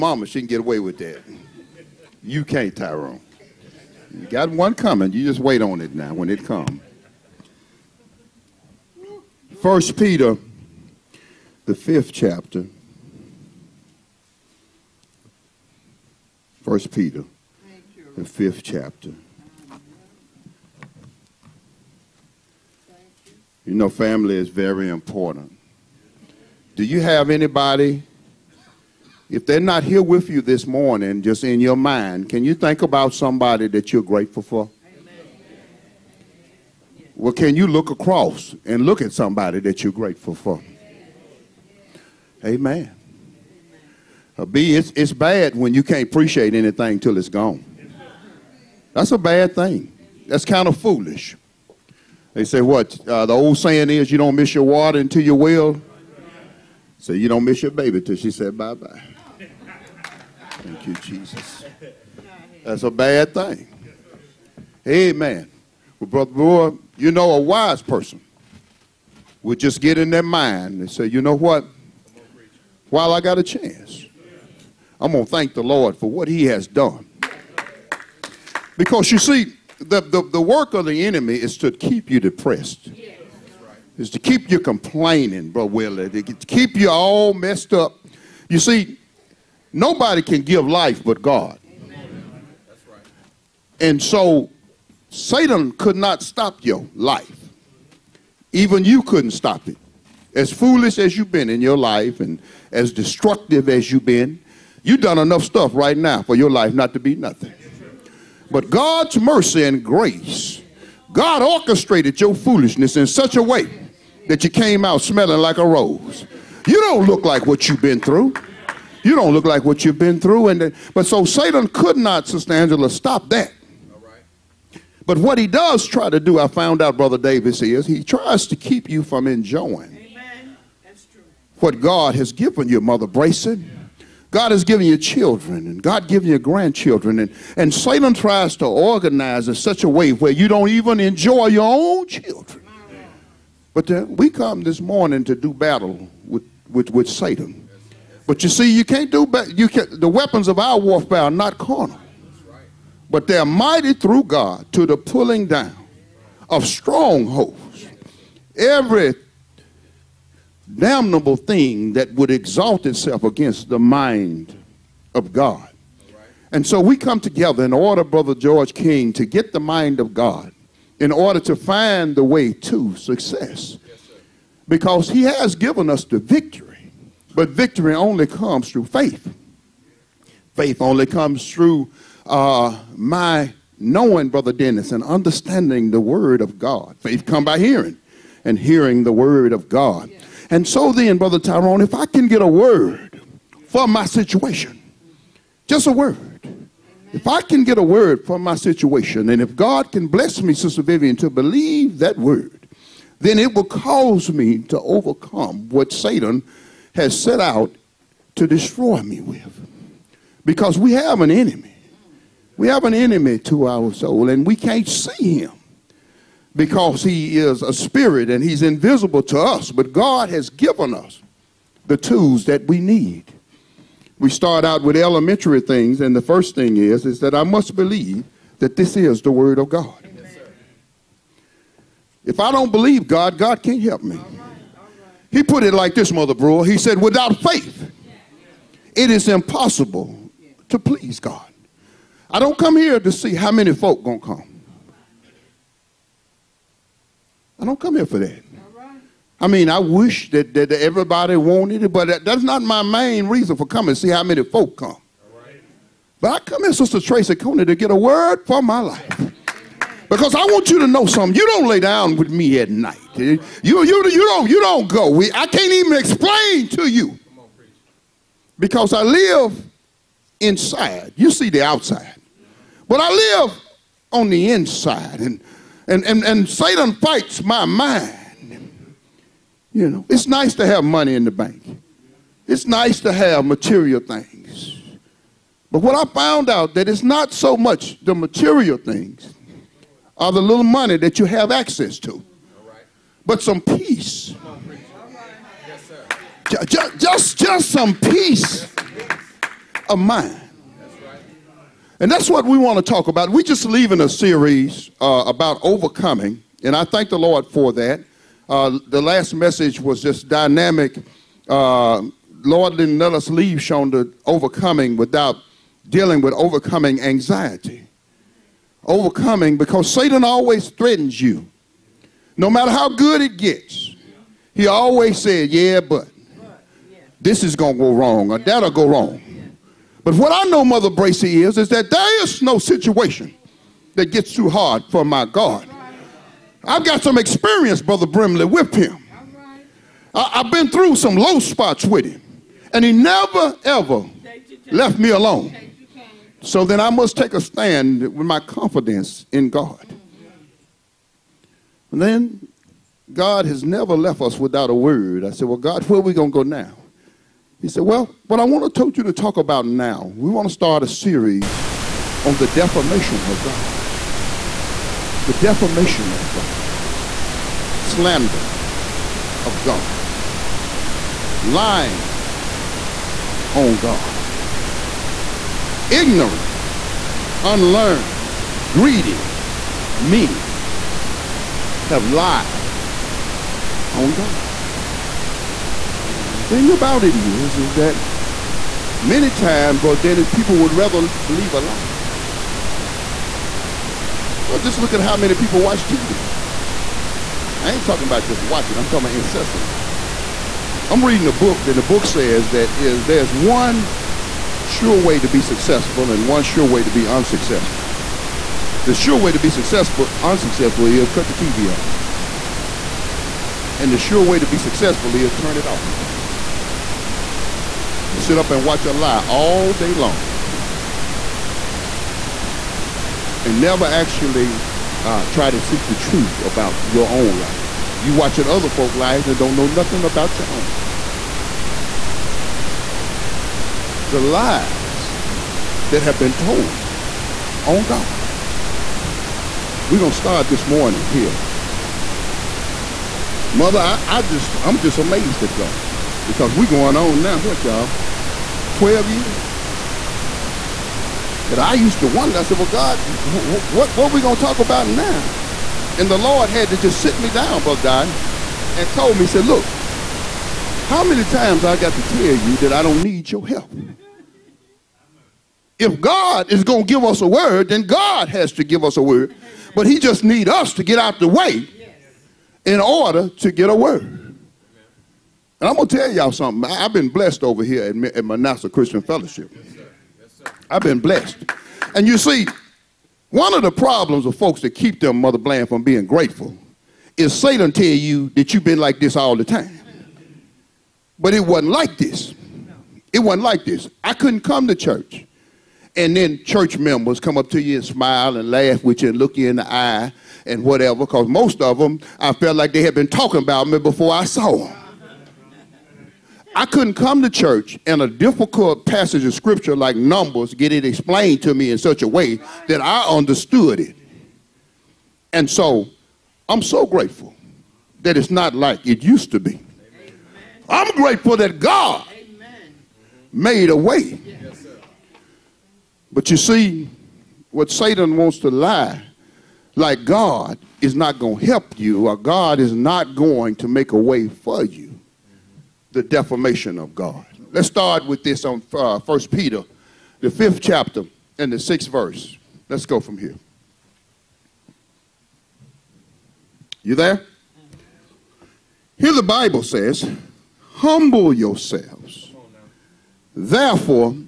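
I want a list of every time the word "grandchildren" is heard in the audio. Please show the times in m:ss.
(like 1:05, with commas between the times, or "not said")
2:16.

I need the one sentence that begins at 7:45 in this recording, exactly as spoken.
If God is going to give us a word, then God has to give us a word.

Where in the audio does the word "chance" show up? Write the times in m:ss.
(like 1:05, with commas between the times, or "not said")
1:13.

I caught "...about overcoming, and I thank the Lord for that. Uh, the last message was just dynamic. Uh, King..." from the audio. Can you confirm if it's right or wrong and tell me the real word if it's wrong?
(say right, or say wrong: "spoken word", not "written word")
wrong: "Lord", not "King".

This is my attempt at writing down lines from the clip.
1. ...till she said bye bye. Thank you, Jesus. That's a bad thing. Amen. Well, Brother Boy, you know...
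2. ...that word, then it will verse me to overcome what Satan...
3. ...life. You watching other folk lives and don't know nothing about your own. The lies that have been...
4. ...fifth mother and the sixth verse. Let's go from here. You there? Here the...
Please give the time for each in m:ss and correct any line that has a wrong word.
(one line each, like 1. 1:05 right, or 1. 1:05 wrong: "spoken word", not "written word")
1. 0:58 right
2. 3:21 wrong: "cause", not "verse"
3. 7:07 right
4. 9:00 wrong: "chapter", not "mother".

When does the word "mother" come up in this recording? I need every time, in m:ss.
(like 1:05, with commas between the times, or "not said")
2:12, 3:56, 5:30, 7:23, 8:05.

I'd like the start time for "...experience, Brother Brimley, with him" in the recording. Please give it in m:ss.
5:37.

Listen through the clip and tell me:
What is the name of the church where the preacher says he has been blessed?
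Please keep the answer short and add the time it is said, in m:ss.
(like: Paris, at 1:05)
Manasseh Christian Fellowship, at 7:58.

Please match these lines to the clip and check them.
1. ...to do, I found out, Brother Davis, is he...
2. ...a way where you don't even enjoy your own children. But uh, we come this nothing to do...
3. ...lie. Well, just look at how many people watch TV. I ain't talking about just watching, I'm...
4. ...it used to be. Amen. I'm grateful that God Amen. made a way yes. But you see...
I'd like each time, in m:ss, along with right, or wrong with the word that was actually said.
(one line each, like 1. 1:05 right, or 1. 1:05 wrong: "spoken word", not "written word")
1. 2:06 right
2. 2:19 wrong: "morning", not "nothing"
3. 6:31 right
4. 8:38 right.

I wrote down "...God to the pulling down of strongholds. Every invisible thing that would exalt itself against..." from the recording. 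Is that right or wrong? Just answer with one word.
wrong.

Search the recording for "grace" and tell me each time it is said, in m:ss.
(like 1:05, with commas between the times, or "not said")
1:49.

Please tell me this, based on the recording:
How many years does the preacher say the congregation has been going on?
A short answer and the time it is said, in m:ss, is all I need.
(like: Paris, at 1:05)
12, at 7:28.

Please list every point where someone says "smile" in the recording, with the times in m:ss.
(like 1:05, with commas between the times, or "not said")
8:17.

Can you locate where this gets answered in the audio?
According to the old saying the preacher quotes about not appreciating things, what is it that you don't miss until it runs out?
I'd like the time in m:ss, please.
0:54.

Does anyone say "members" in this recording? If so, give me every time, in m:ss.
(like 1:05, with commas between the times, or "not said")
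8:16.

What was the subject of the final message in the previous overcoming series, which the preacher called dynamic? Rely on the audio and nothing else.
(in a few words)
Overcoming anxiety.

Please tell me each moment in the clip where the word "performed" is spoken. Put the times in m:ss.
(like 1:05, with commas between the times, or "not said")
not said.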